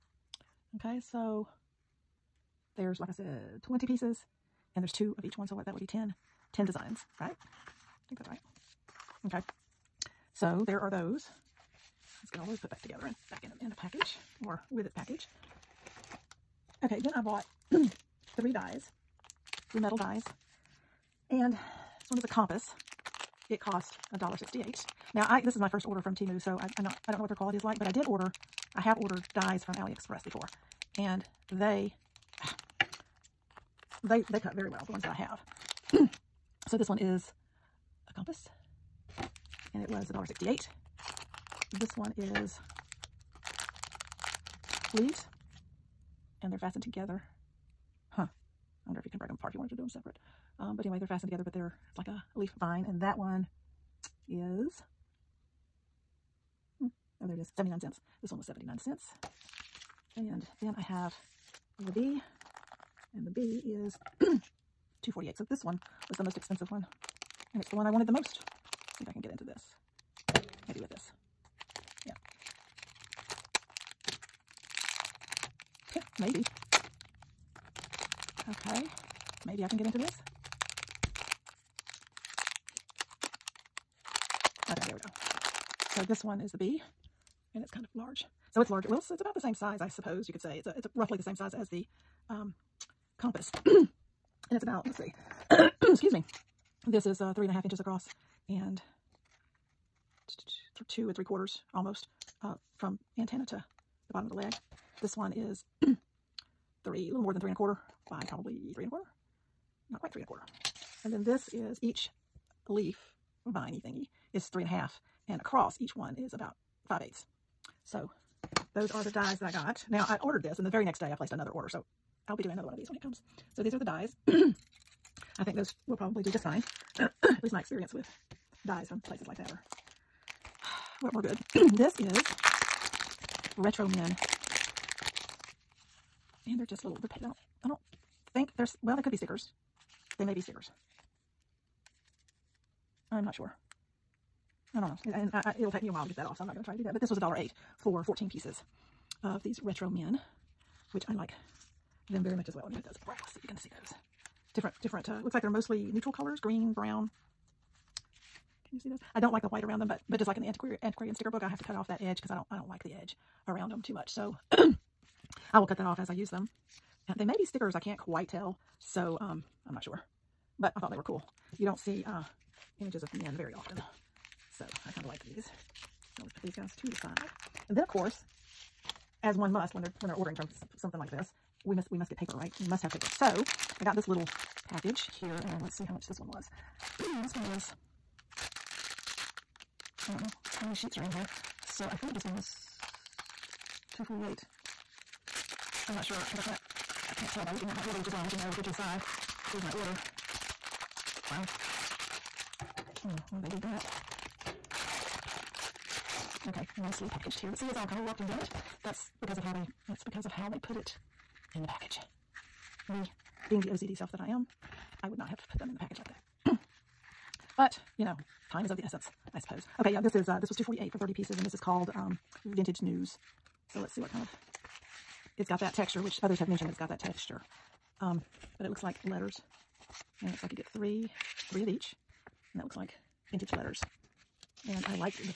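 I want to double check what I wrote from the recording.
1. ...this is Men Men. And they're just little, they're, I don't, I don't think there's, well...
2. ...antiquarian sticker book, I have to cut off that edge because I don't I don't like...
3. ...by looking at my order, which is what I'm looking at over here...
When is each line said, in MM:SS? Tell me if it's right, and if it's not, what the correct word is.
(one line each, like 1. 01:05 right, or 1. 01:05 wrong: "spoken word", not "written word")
1. 02:11 wrong: "Retro", not "Men"
2. 02:40 right
3. 03:17 right.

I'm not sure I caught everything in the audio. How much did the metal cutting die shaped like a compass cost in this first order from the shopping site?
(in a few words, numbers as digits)
$1.68.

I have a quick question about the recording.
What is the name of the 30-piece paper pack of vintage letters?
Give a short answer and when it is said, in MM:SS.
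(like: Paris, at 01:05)
Vintage News, at 03:42.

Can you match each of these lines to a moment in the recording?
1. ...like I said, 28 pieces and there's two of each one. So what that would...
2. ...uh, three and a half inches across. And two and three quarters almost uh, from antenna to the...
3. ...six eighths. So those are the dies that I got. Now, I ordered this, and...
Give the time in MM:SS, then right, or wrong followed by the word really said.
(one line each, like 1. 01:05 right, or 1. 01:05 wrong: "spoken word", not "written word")
1. 00:02 wrong: "20", not "28"
2. 01:37 right
3. 01:56 wrong: "five", not "six".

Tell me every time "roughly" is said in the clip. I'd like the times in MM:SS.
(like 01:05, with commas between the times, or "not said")
01:30.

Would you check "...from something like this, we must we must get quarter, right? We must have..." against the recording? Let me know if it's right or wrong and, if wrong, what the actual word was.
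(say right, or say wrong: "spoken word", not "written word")
wrong: "paper", not "quarter".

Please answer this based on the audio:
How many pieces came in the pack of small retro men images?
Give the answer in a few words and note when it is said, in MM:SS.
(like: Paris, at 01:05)
14, at 02:28.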